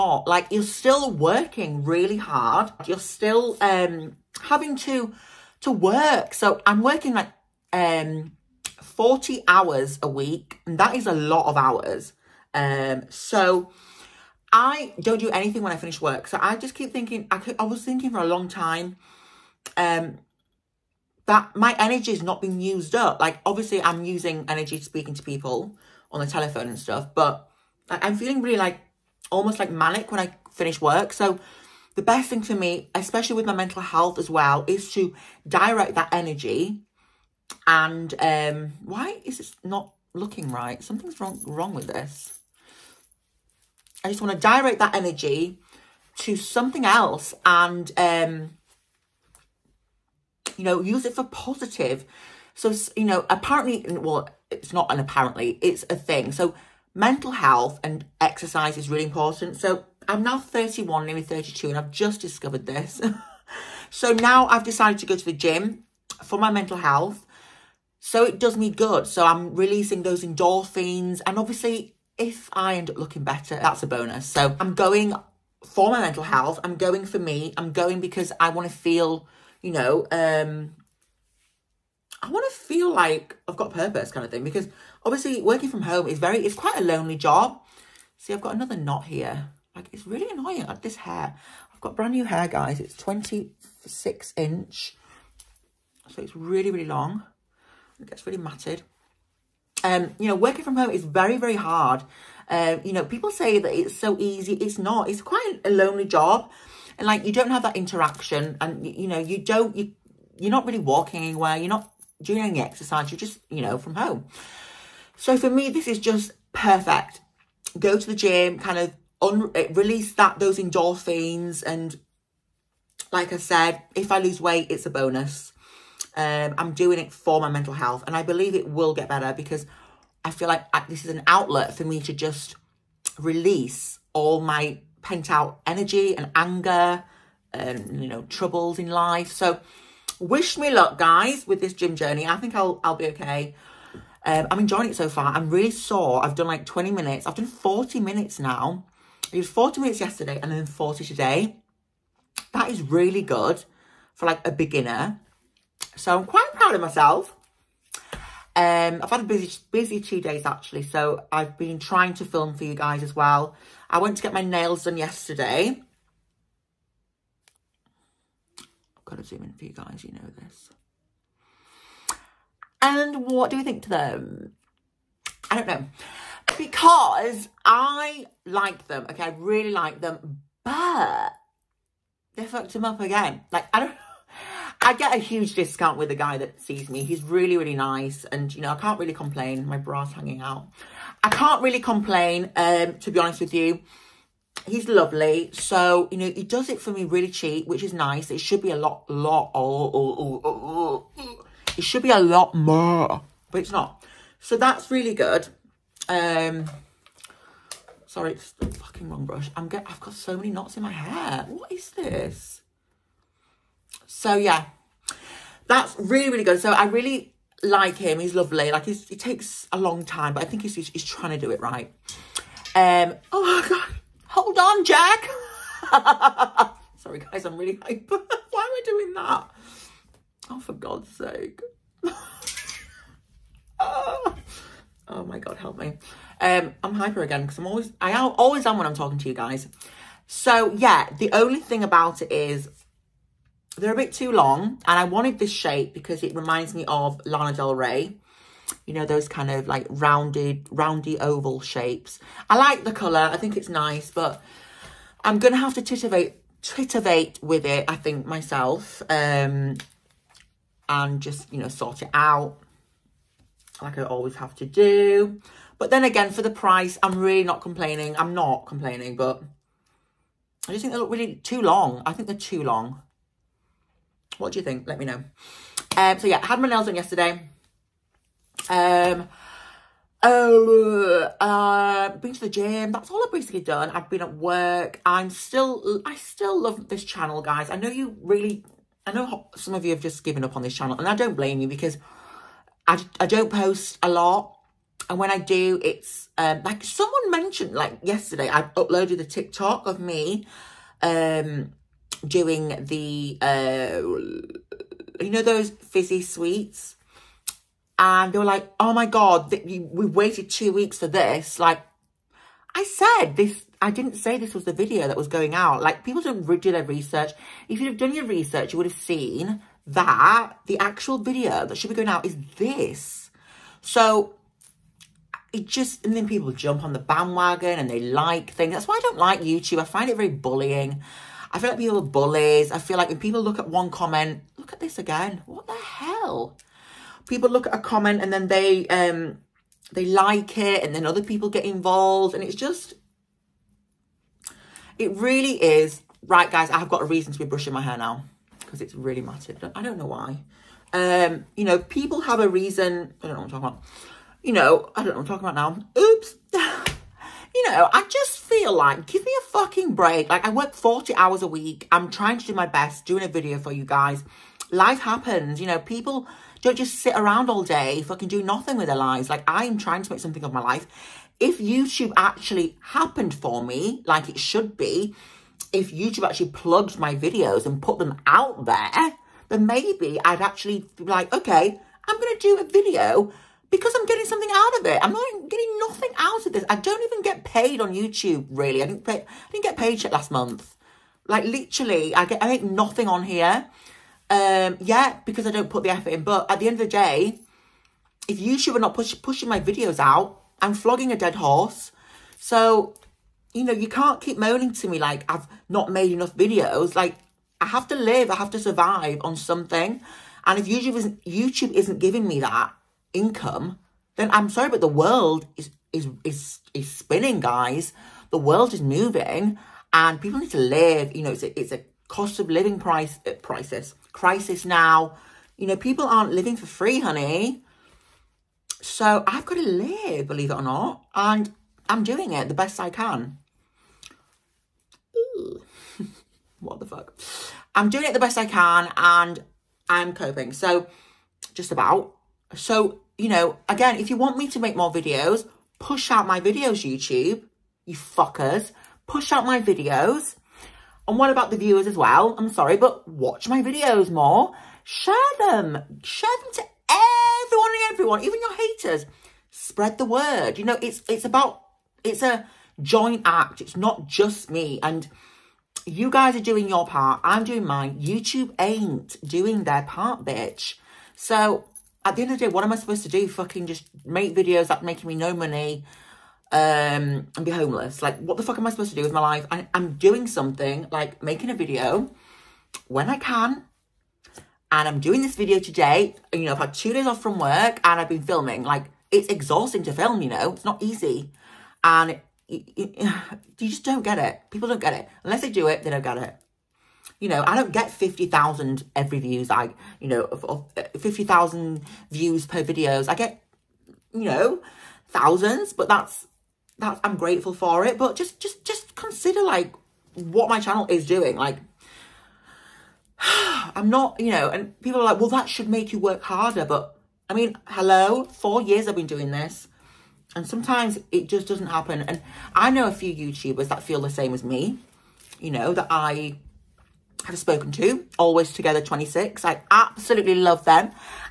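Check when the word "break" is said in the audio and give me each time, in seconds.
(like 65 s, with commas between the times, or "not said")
359 s.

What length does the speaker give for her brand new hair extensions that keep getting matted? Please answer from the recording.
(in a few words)
26 inch.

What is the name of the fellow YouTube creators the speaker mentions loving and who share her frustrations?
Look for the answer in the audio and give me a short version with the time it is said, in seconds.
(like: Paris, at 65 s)
Always Together 26, at 528 s.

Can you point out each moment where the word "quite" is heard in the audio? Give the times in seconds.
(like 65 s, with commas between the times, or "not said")
86 s, 105 s, 156 s.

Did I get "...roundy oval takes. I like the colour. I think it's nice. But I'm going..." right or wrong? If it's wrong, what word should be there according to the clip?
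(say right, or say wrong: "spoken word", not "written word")
wrong: "shapes", not "takes".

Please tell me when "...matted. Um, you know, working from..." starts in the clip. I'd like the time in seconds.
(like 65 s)
98 s.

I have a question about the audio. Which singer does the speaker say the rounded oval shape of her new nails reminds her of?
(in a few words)
Lana Del Rey.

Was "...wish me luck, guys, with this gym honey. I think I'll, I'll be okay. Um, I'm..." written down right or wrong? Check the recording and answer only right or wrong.
wrong.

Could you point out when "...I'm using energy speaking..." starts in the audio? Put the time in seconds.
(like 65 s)
23 s.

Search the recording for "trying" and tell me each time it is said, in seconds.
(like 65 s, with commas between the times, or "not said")
161 s, 221 s, 362 s, 369 s.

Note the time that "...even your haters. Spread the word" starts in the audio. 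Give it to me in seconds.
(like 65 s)
458 s.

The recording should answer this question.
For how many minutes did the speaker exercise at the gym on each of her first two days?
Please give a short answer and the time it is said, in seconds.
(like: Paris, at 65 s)
40, at 150 s.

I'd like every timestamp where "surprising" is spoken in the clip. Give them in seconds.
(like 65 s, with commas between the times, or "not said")
not said.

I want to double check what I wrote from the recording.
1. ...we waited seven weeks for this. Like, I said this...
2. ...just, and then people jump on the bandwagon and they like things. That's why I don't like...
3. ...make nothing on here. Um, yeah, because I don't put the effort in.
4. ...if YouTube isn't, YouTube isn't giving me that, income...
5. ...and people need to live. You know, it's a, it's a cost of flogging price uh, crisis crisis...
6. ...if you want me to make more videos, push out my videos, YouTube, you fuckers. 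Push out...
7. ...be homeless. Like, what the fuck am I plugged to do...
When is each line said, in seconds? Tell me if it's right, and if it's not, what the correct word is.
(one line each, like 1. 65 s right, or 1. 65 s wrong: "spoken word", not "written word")
1. 309 s wrong: "two", not "seven"
2. 325 s right
3. 392 s right
4. 410 s right
5. 419 s wrong: "living", not "flogging"
6. 443 s right
7. 477 s wrong: "supposed", not "plugged".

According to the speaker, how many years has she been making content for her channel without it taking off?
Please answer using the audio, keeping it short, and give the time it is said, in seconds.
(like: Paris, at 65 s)
4, at 518 s.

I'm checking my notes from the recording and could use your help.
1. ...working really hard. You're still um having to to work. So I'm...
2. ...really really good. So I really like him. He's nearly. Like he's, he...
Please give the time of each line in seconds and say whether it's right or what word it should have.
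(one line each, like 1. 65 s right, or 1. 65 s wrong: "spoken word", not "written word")
1. 1 s right
2. 215 s wrong: "lovely", not "nearly".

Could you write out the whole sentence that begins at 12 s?
Um so I don't do anything when I finish work.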